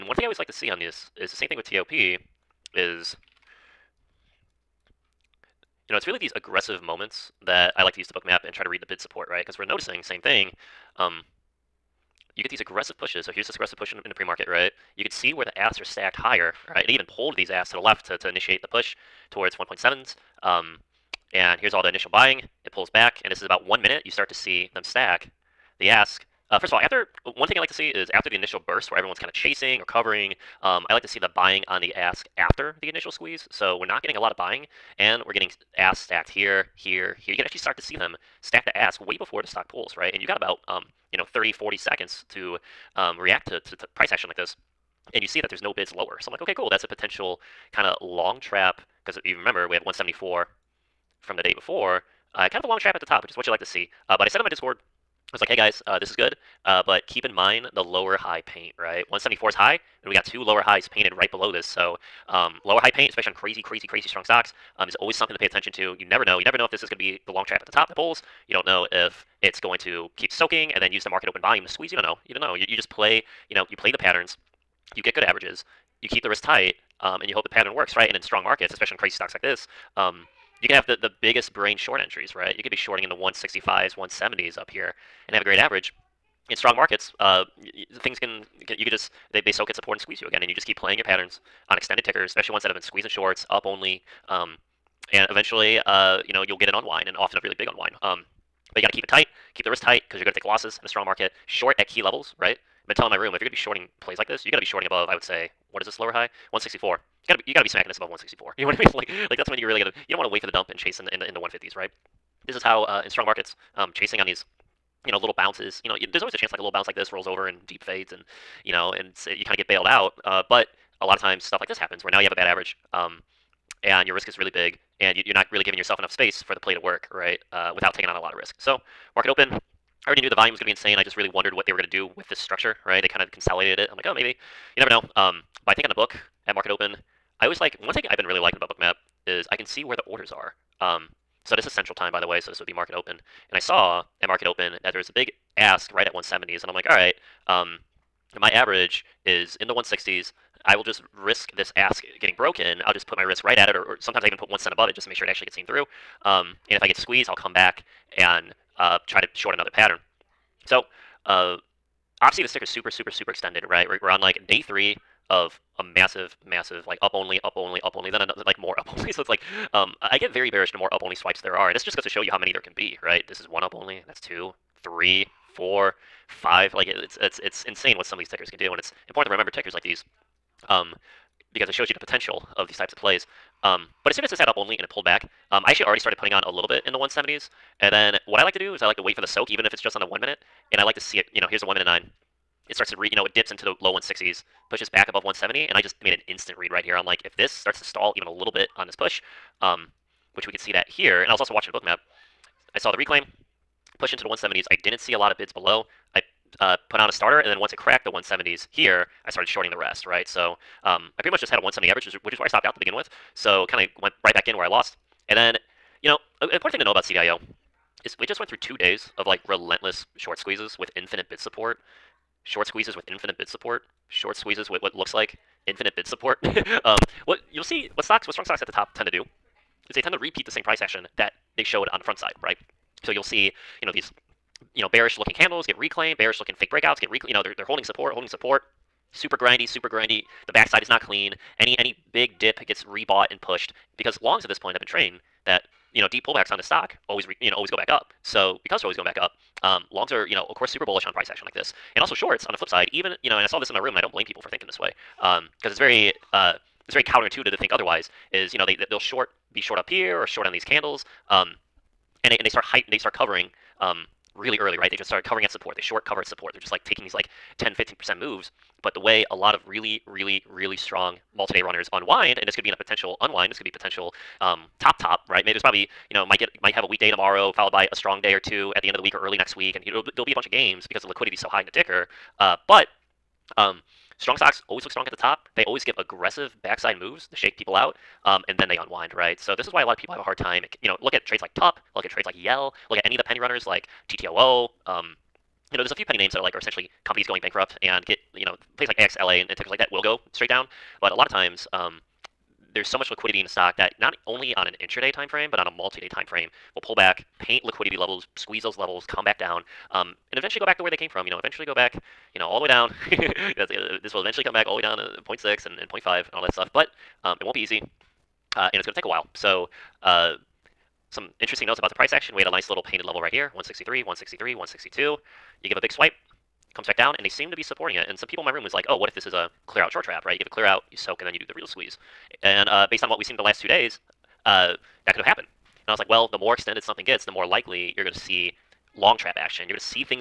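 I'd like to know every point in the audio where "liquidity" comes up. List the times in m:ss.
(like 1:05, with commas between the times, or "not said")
4:41, 5:03, 5:07.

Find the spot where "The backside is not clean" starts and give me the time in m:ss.
4:00.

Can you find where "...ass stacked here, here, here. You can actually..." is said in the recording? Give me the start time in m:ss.
0:35.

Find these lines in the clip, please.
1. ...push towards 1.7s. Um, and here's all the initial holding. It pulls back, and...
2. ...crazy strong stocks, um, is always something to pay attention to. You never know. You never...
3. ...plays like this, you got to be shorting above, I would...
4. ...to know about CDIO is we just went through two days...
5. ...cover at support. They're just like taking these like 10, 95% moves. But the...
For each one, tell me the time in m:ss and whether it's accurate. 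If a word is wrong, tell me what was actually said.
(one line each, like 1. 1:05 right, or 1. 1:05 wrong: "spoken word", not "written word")
1. 0:18 wrong: "buying", not "holding"
2. 1:03 right
3. 1:44 right
4. 3:36 right
5. 4:26 wrong: "15", not "95".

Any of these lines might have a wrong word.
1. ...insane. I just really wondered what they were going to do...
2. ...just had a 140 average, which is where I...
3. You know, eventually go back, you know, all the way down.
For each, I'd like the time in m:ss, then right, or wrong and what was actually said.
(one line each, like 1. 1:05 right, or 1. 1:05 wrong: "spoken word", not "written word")
1. 2:10 right
2. 3:31 wrong: "170", not "140"
3. 5:11 right.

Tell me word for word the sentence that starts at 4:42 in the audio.
Uh, but um, strong stocks always look strong at the top.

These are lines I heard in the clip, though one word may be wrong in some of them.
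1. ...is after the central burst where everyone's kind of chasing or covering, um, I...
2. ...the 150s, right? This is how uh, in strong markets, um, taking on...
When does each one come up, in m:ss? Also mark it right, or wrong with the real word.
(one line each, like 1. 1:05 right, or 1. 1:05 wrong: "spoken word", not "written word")
1. 0:27 wrong: "initial", not "central"
2. 1:51 wrong: "chasing", not "taking".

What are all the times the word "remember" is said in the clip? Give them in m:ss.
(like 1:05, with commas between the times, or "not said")
0:49, 2:59.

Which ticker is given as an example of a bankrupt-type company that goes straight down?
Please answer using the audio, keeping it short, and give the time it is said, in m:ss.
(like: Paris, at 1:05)
AXLA, at 4:58.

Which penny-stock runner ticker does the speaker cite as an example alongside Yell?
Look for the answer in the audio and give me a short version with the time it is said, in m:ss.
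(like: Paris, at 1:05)
TTOO, at 4:54.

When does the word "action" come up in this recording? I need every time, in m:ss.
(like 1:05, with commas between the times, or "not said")
0:44, 3:50, 4:11, 5:22, 5:39.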